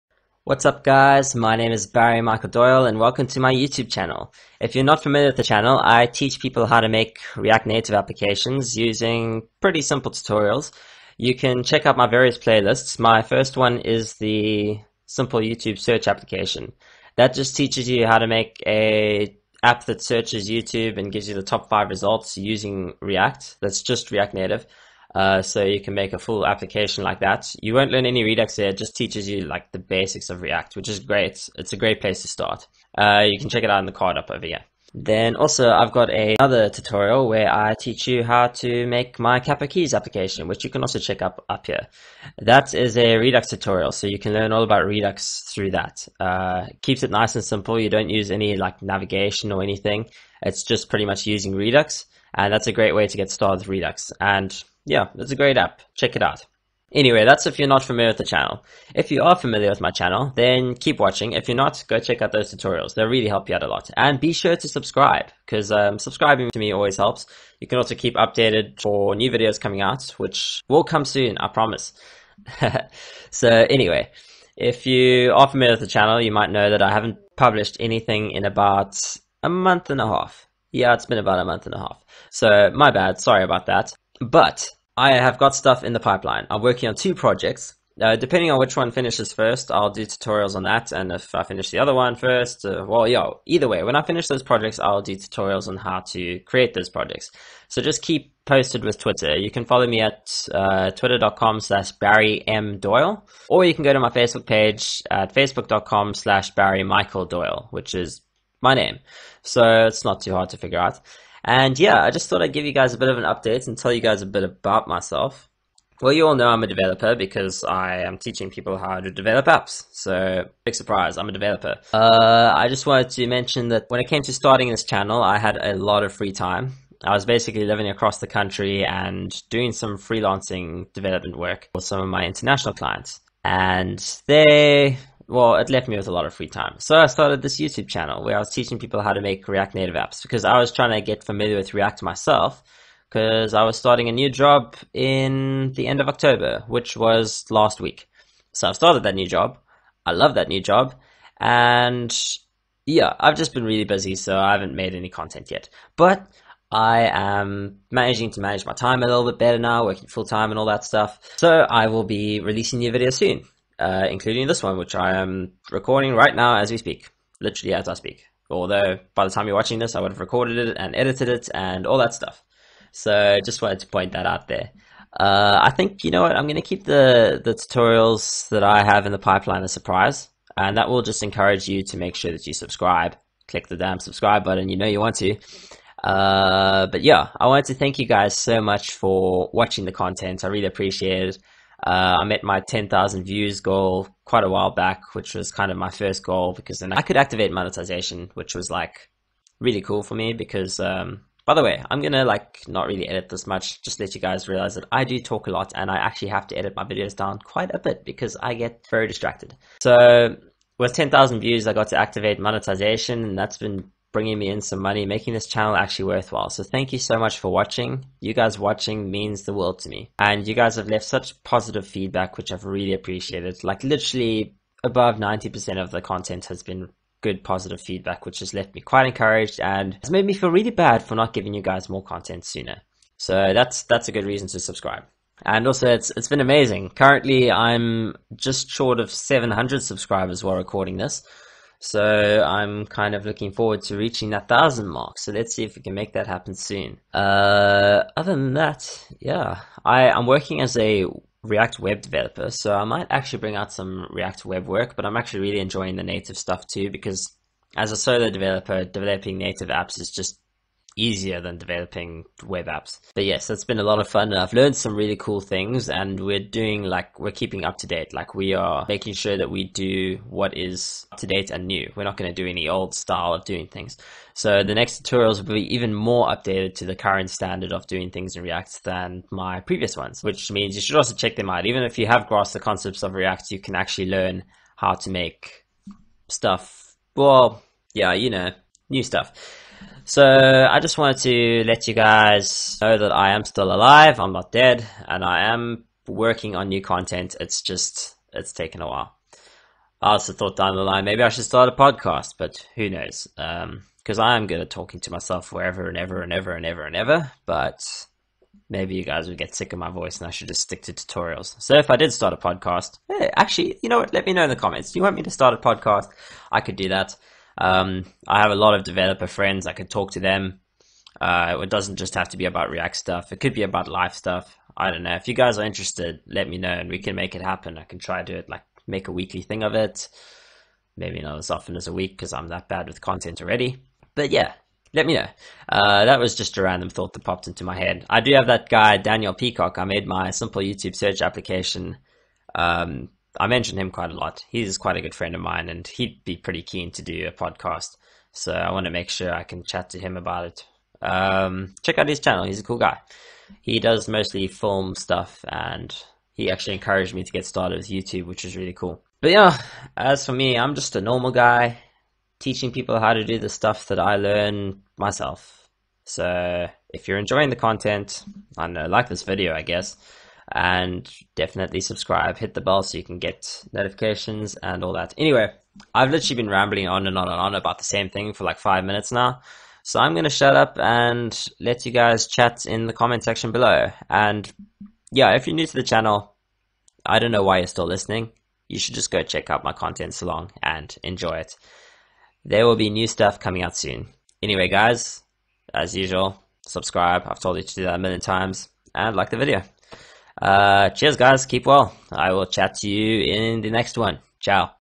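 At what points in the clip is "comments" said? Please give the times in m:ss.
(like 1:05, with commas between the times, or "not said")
5:14, 6:22.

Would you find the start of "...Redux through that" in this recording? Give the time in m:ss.
0:44.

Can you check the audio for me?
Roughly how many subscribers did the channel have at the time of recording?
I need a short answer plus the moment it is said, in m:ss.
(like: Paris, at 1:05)
700, at 3:59.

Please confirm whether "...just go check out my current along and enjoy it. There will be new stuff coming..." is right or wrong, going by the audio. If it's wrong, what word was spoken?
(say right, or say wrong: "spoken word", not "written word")
wrong: "content", not "current".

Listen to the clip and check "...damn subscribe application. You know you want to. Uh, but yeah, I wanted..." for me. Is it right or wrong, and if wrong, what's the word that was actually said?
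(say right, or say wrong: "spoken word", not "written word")
wrong: "button", not "application".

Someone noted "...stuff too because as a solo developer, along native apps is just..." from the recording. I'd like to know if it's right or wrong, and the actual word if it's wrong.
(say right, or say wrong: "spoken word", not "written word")
wrong: "developing", not "along".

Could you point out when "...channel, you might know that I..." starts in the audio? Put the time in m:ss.
1:15.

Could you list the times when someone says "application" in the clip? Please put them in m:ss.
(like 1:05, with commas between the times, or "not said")
0:07, 0:16, 0:26, 0:39, 5:41.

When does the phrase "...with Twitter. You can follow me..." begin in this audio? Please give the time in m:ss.
1:38.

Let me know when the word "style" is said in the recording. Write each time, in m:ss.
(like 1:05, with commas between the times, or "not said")
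4:32.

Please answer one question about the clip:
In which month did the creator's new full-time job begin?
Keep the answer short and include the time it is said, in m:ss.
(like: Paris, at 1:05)
October, at 2:26.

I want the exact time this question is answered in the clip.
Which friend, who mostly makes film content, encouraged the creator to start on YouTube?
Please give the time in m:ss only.
5:38.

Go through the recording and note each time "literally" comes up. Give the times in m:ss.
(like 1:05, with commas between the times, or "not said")
2:47, 3:43, 6:16.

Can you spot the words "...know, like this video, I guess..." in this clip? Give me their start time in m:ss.
6:08.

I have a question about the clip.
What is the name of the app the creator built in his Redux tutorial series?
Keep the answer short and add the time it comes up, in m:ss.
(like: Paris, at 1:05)
Capo Keys, at 0:39.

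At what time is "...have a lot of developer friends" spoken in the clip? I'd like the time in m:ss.
5:18.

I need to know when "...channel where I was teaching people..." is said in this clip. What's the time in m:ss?
2:17.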